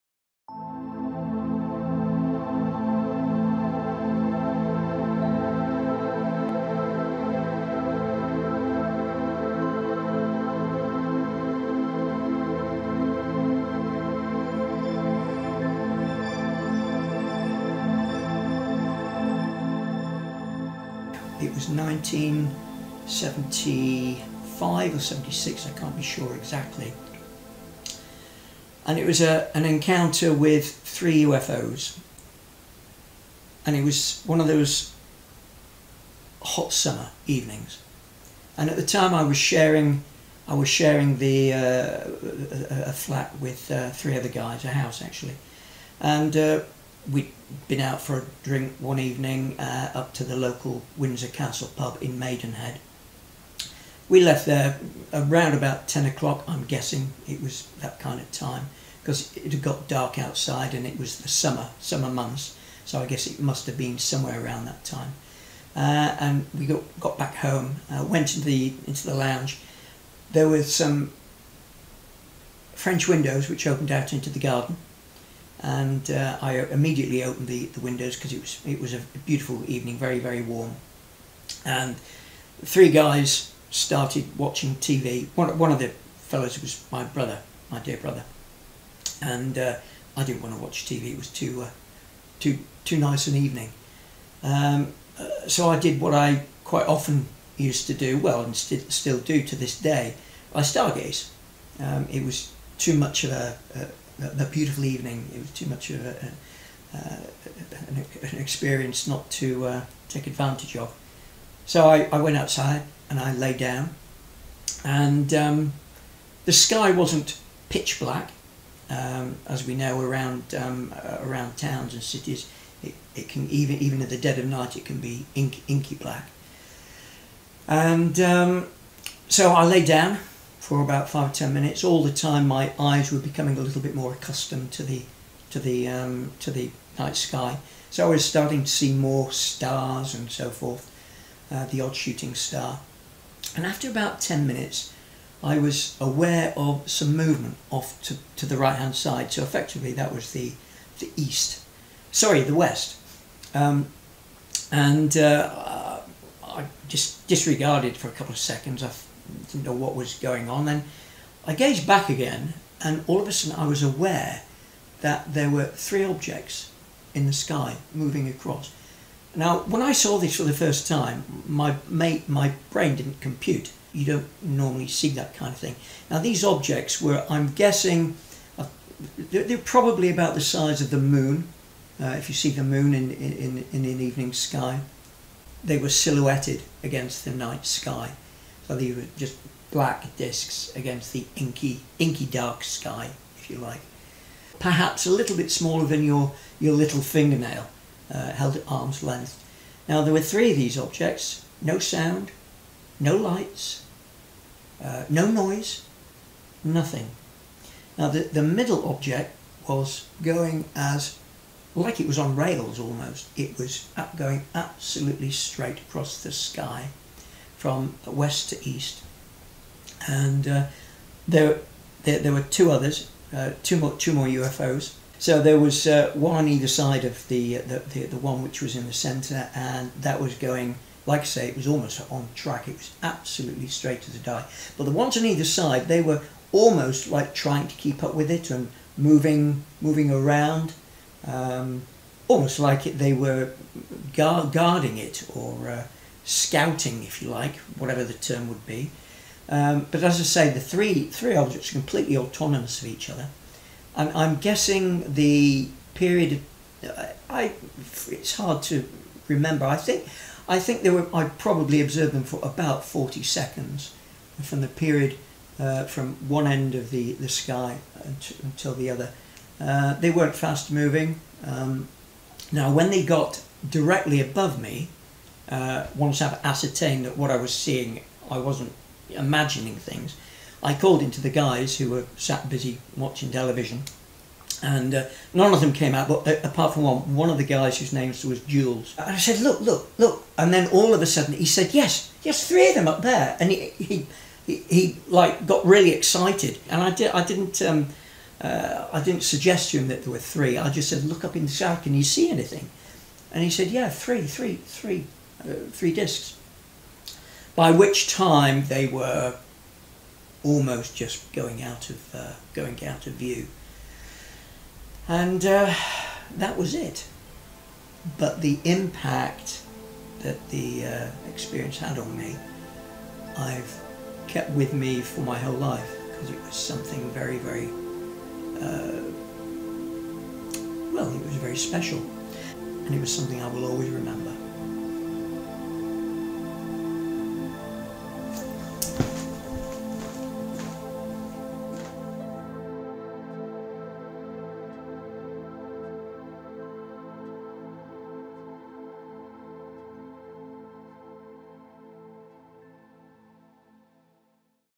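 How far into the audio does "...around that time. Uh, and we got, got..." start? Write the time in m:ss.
1:04.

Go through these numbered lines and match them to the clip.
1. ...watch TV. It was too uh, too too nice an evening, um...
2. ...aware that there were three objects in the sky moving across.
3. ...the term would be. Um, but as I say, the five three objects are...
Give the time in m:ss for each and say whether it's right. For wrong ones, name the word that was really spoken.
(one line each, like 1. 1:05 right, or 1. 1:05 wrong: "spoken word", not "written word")
1. 1:30 right
2. 2:43 right
3. 4:08 wrong: "three", not "five".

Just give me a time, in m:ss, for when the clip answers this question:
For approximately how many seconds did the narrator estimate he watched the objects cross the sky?
4:22.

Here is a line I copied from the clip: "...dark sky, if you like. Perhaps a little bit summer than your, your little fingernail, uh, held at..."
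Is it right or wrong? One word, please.
wrong.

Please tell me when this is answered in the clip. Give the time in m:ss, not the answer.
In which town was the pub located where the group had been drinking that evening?
0:52.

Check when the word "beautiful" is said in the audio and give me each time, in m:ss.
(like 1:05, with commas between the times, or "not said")
1:19, 1:44.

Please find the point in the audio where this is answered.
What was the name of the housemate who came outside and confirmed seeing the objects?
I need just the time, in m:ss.
4:48.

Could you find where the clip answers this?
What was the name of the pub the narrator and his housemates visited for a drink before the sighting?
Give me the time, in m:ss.
0:50.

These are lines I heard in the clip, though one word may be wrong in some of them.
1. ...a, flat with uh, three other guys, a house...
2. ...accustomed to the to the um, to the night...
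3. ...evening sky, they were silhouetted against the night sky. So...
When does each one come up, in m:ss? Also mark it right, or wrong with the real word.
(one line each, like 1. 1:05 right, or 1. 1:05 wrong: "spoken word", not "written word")
1. 0:42 right
2. 2:14 right
3. 3:04 right.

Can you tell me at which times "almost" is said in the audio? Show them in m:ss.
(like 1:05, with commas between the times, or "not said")
3:32, 3:51, 3:56, 4:02, 5:10.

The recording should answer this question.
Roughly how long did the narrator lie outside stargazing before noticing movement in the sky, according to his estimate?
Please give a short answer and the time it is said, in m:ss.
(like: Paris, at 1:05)
10 minutes, at 2:23.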